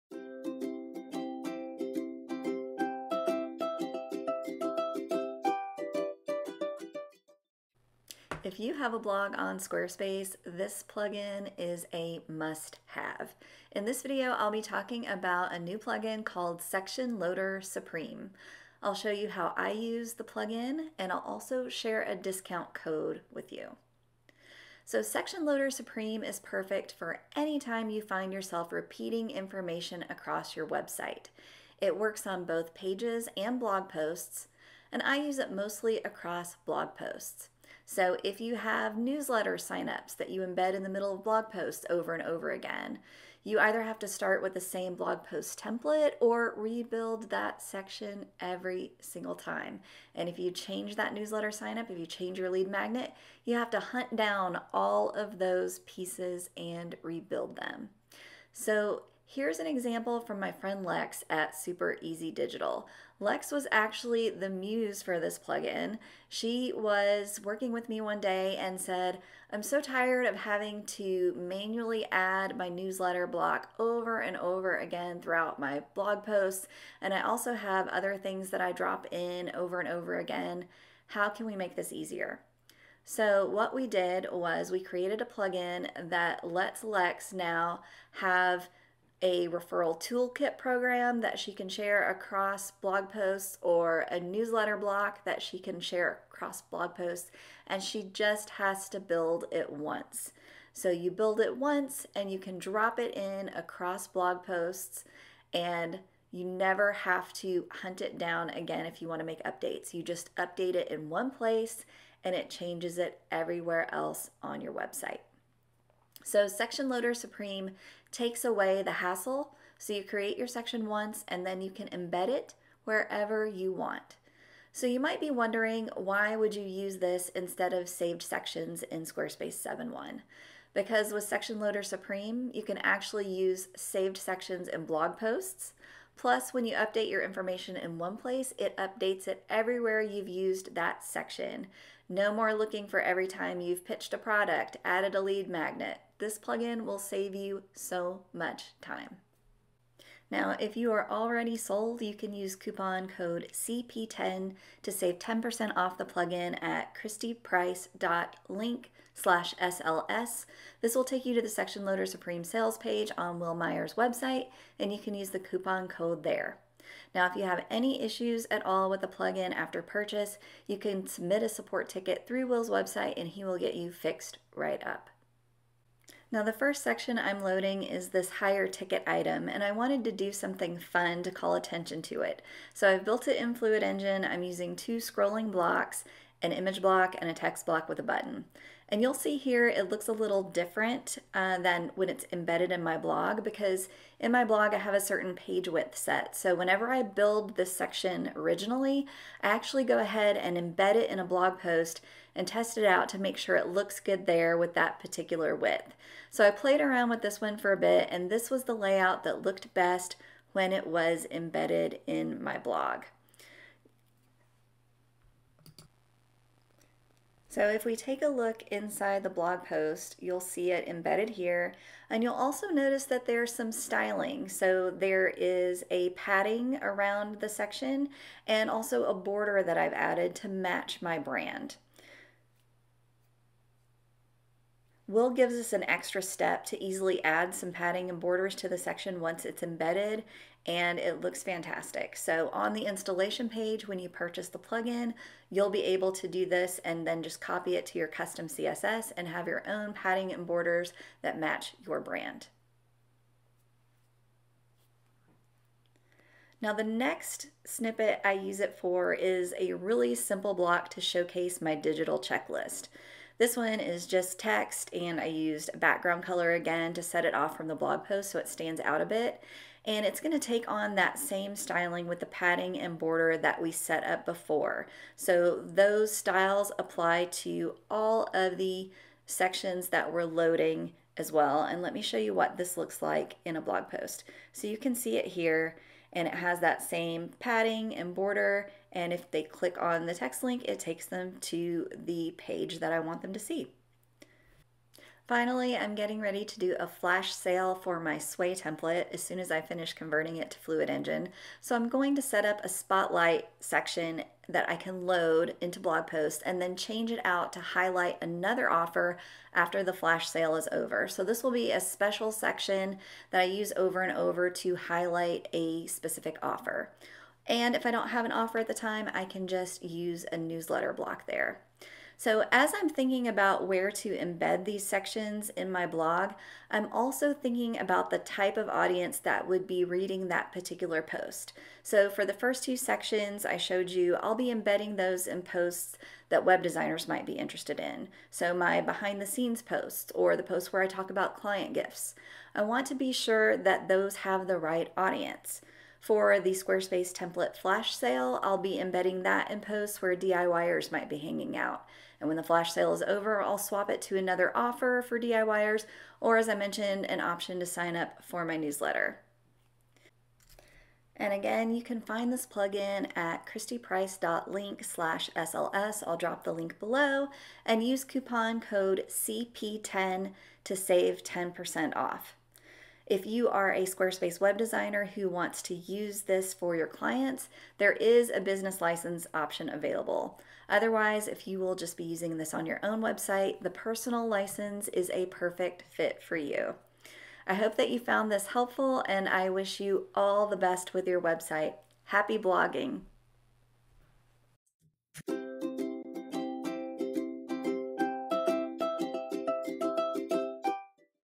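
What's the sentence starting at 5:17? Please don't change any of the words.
And if I don't have an offer at the time, I can just use a newsletter block there.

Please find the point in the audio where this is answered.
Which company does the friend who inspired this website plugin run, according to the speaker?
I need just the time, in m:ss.
1:01.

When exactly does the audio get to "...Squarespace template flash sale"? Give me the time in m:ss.
5:46.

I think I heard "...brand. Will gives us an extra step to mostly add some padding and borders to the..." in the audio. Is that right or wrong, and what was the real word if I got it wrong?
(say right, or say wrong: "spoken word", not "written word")
wrong: "easily", not "mostly".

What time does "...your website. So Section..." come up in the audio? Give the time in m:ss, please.
1:54.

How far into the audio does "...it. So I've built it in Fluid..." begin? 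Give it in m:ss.
3:02.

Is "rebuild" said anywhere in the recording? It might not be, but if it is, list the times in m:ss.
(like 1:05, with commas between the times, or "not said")
0:46, 0:57.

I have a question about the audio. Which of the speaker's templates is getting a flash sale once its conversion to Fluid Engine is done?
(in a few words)
Sway.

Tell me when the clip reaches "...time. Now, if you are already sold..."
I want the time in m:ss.
2:28.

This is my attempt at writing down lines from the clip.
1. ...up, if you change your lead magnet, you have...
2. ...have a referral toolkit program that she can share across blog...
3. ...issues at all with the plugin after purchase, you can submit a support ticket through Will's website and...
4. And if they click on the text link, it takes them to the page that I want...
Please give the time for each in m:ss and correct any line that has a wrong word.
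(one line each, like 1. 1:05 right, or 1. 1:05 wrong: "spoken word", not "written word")
1. 0:51 right
2. 1:28 right
3. 2:48 right
4. 4:48 right.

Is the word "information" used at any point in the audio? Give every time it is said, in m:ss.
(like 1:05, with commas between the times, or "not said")
0:29, 2:17.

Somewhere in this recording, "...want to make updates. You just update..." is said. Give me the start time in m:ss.
1:49.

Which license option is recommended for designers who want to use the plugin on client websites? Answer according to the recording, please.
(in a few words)
business license.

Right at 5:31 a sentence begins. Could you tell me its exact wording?
So for the first two sections I showed you, I'll be embedding those in posts that web designers might be interested in.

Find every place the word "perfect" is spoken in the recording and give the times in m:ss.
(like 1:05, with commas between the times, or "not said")
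0:26, 6:25.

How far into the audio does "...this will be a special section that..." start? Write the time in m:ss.
5:11.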